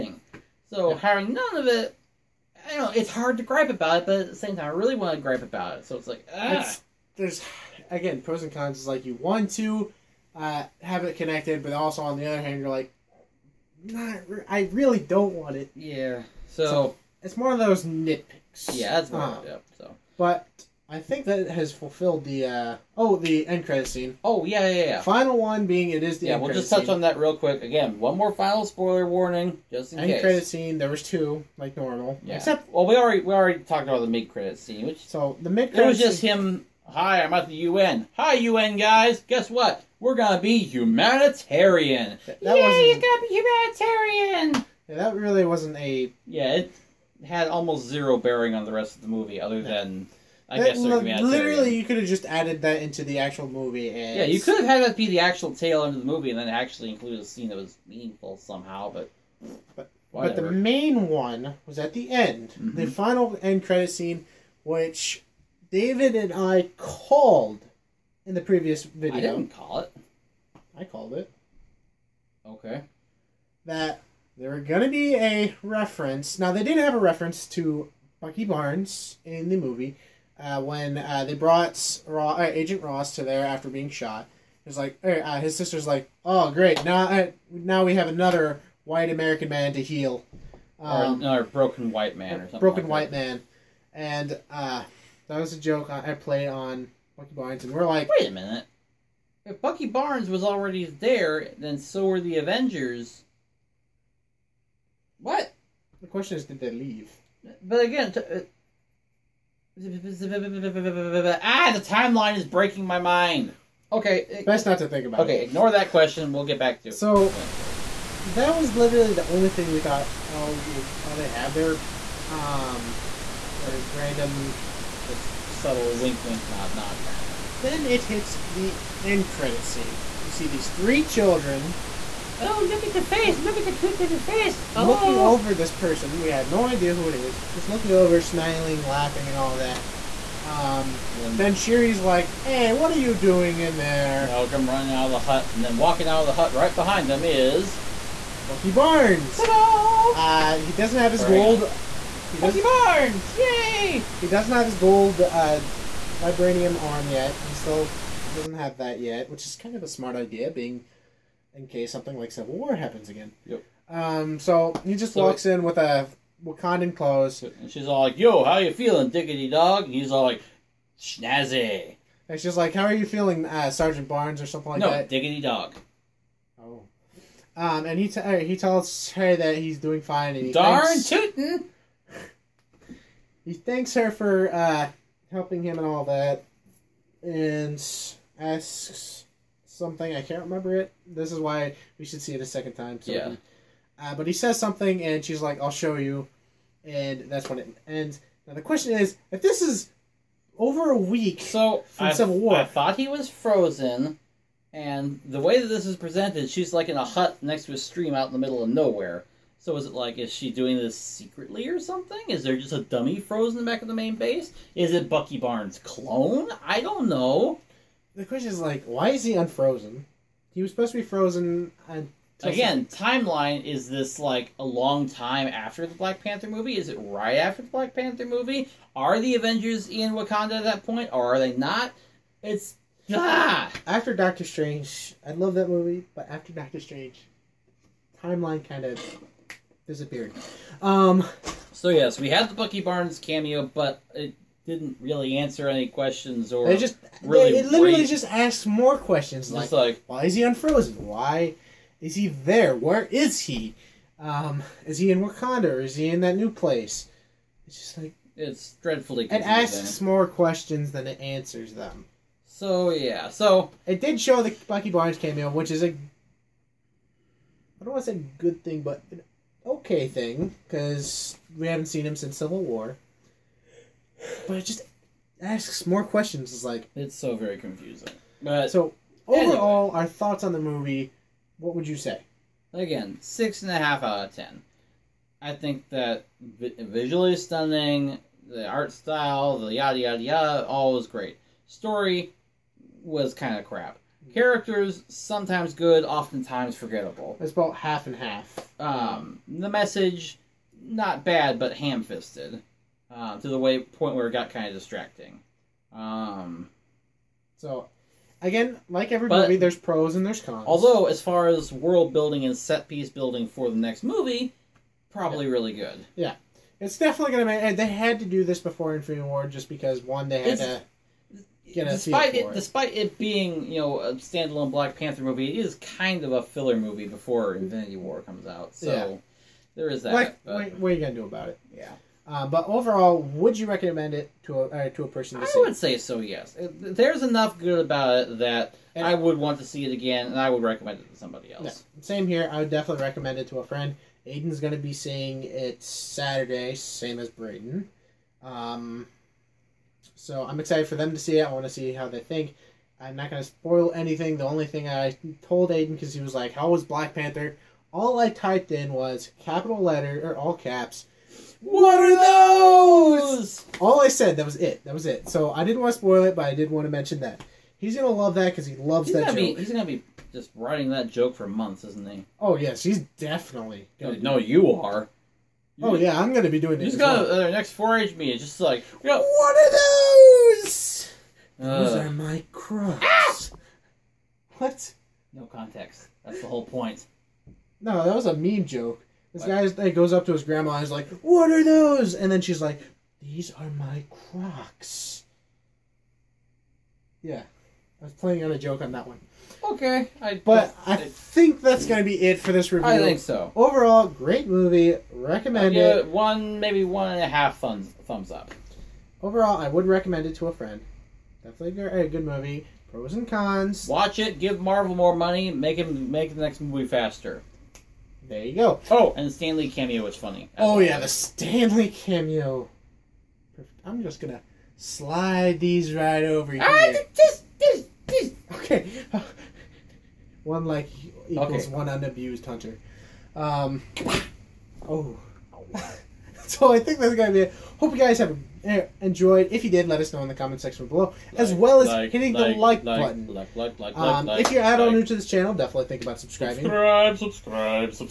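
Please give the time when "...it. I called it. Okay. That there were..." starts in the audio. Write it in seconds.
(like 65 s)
69 s.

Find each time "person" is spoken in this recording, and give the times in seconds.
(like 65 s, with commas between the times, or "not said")
135 s, 335 s.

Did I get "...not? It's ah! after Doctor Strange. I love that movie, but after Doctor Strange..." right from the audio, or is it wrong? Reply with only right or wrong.
right.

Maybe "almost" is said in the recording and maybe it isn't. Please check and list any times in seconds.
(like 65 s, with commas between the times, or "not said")
47 s.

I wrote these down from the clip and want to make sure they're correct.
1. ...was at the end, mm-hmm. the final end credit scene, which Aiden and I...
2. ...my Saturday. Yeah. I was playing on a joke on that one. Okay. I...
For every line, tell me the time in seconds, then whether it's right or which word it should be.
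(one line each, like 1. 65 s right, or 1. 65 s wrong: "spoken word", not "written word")
1. 61 s wrong: "David", not "Aiden"
2. 393 s wrong: "Crocs", not "Saturday".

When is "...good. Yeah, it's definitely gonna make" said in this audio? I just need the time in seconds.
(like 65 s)
315 s.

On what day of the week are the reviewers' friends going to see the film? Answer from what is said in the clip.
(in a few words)
Saturday.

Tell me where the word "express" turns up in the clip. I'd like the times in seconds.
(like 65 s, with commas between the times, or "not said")
not said.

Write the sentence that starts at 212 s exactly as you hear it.
Is there just a dummy frozen back of the main base?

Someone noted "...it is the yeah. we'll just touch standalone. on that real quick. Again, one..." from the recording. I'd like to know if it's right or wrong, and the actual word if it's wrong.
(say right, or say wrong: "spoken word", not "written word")
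wrong: "scene", not "standalone".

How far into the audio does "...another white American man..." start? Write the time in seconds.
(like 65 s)
88 s.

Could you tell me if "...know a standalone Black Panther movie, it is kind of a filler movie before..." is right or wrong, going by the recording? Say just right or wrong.
right.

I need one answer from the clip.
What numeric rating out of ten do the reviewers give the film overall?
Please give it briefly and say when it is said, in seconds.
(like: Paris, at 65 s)
6.5, at 283 s.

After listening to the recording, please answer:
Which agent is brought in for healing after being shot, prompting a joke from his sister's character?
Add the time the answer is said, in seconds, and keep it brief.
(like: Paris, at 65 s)
Agent Ross, at 82 s.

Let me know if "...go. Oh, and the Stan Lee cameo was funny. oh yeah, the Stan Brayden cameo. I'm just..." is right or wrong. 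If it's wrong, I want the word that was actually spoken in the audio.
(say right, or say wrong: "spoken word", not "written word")
wrong: "Lee", not "Brayden".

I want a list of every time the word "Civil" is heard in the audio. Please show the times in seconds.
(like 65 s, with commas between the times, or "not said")
162 s, 202 s, 272 s.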